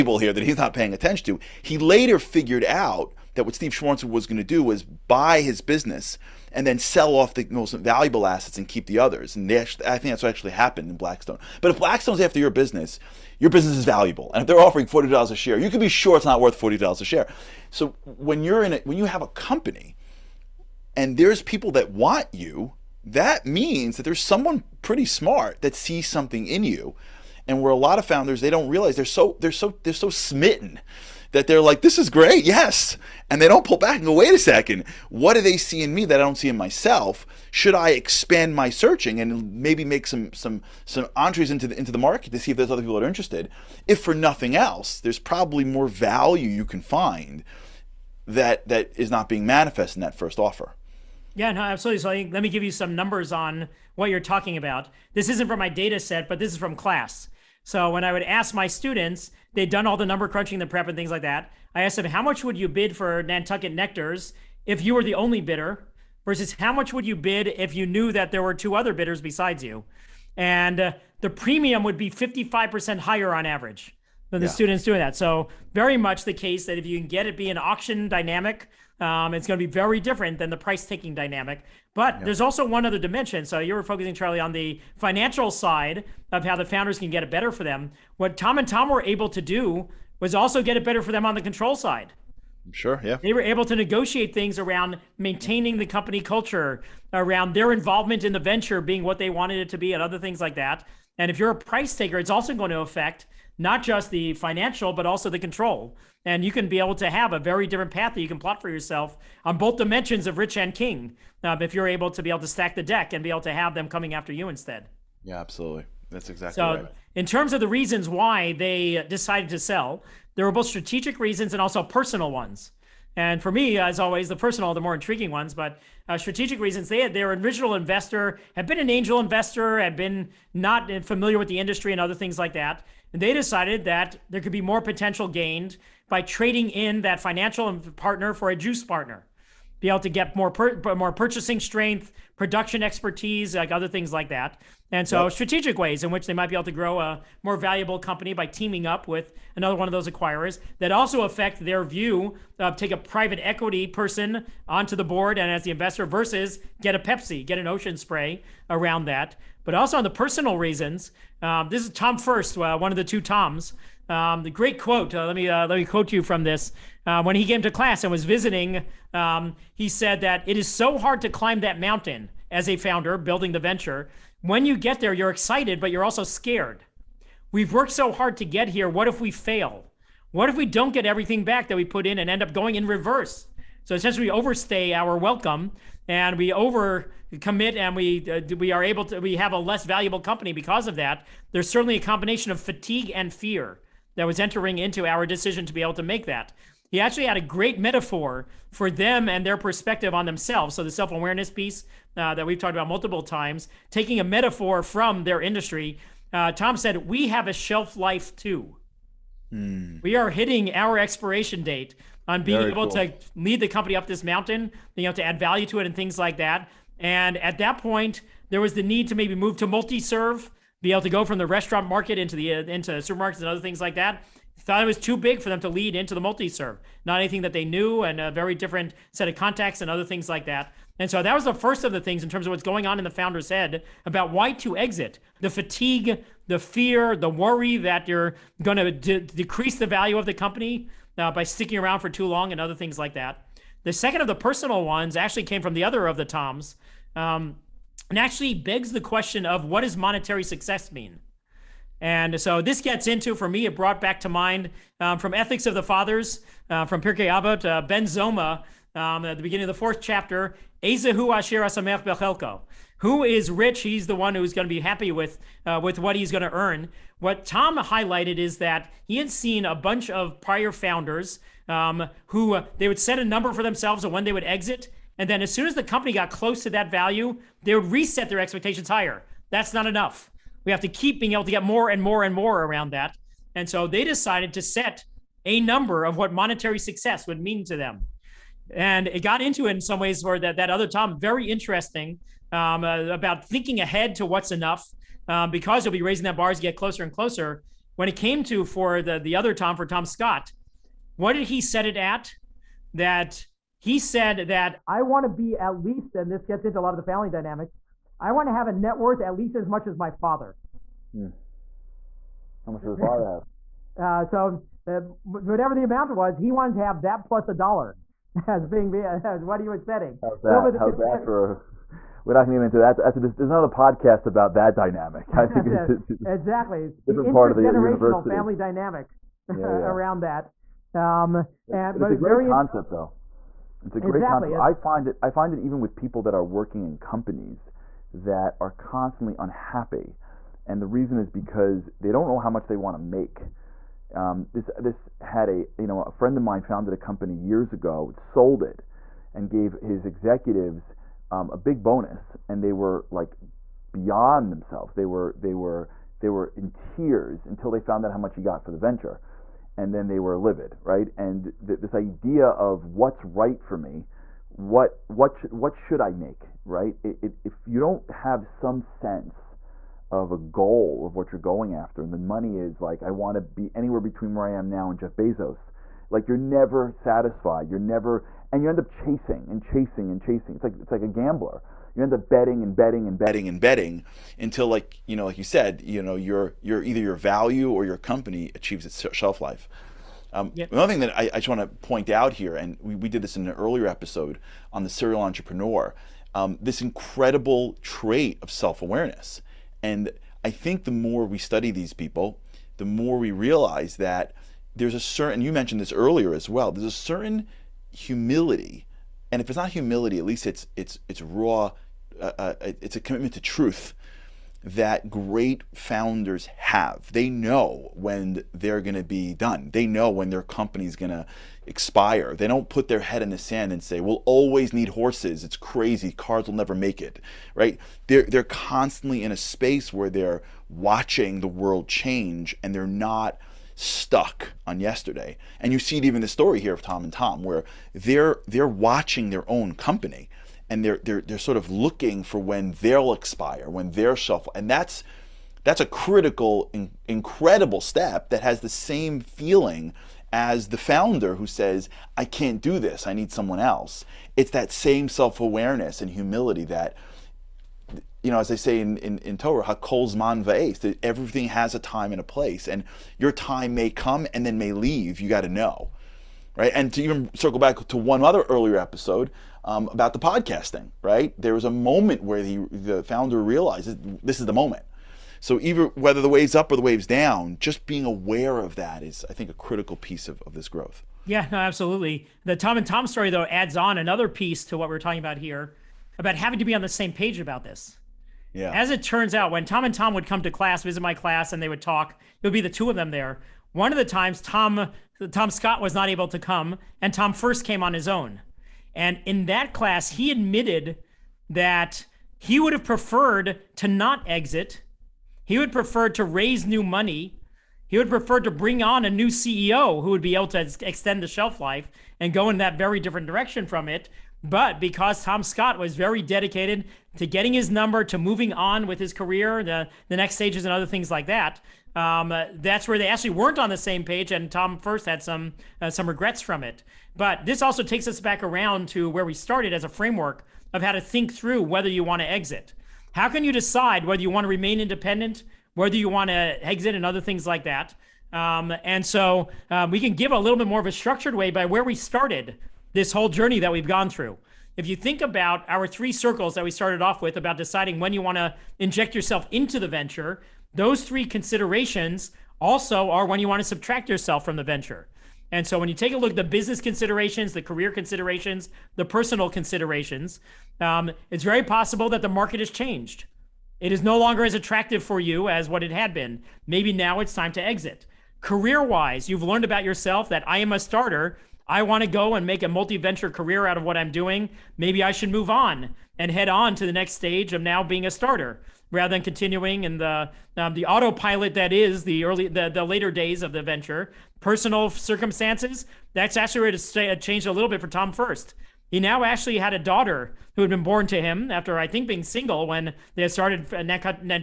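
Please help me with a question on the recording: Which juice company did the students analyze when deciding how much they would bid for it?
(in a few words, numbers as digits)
Nantucket Nectars.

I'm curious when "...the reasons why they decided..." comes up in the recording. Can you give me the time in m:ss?
1:57.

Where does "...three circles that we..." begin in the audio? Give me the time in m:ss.
9:05.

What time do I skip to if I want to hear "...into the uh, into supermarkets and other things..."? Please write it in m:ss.
3:42.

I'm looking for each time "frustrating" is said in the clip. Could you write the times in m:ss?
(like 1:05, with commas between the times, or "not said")
not said.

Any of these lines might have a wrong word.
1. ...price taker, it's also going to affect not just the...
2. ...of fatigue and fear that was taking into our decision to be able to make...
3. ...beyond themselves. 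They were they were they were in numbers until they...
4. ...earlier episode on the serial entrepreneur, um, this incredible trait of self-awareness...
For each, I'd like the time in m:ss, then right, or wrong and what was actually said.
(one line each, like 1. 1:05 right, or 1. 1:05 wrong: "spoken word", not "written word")
1. 1:41 right
2. 3:12 wrong: "entering", not "taking"
3. 5:53 wrong: "tears", not "numbers"
4. 6:33 right.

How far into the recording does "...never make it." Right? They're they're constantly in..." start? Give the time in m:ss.
7:06.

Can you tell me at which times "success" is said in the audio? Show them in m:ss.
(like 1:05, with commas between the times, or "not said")
4:10, 4:46.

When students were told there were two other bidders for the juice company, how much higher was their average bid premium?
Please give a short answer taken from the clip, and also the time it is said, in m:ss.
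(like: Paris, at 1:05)
55%, at 1:12.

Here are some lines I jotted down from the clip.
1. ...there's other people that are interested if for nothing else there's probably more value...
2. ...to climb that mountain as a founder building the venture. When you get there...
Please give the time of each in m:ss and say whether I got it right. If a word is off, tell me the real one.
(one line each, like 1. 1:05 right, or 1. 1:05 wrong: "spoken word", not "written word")
1. 0:42 right
2. 2:51 right.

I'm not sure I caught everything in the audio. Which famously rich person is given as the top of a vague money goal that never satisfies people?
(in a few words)
Jeff Bezos.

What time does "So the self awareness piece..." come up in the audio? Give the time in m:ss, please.
3:20.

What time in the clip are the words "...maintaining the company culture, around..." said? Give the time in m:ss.
1:35.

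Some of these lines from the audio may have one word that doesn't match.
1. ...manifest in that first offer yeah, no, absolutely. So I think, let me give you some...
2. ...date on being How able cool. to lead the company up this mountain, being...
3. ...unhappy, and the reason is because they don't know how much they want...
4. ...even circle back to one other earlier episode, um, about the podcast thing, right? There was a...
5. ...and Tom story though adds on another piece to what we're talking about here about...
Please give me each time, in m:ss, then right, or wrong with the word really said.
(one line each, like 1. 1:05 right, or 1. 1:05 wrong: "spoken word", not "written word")
1. 0:49 right
2. 3:31 wrong: "Very", not "How"
3. 5:39 right
4. 7:47 right
5. 8:02 right.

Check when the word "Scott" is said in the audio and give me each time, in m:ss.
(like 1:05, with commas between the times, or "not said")
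5:00, 8:15, 8:35.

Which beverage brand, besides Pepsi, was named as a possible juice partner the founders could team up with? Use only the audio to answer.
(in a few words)
Ocean Spray.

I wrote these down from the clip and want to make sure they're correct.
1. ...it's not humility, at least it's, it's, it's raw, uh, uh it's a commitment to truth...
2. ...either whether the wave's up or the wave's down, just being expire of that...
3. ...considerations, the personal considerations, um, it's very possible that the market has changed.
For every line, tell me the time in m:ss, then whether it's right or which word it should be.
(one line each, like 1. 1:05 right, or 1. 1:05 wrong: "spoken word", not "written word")
1. 6:49 right
2. 7:55 wrong: "aware", not "expire"
3. 9:17 right.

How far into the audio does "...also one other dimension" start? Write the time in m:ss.
1:22.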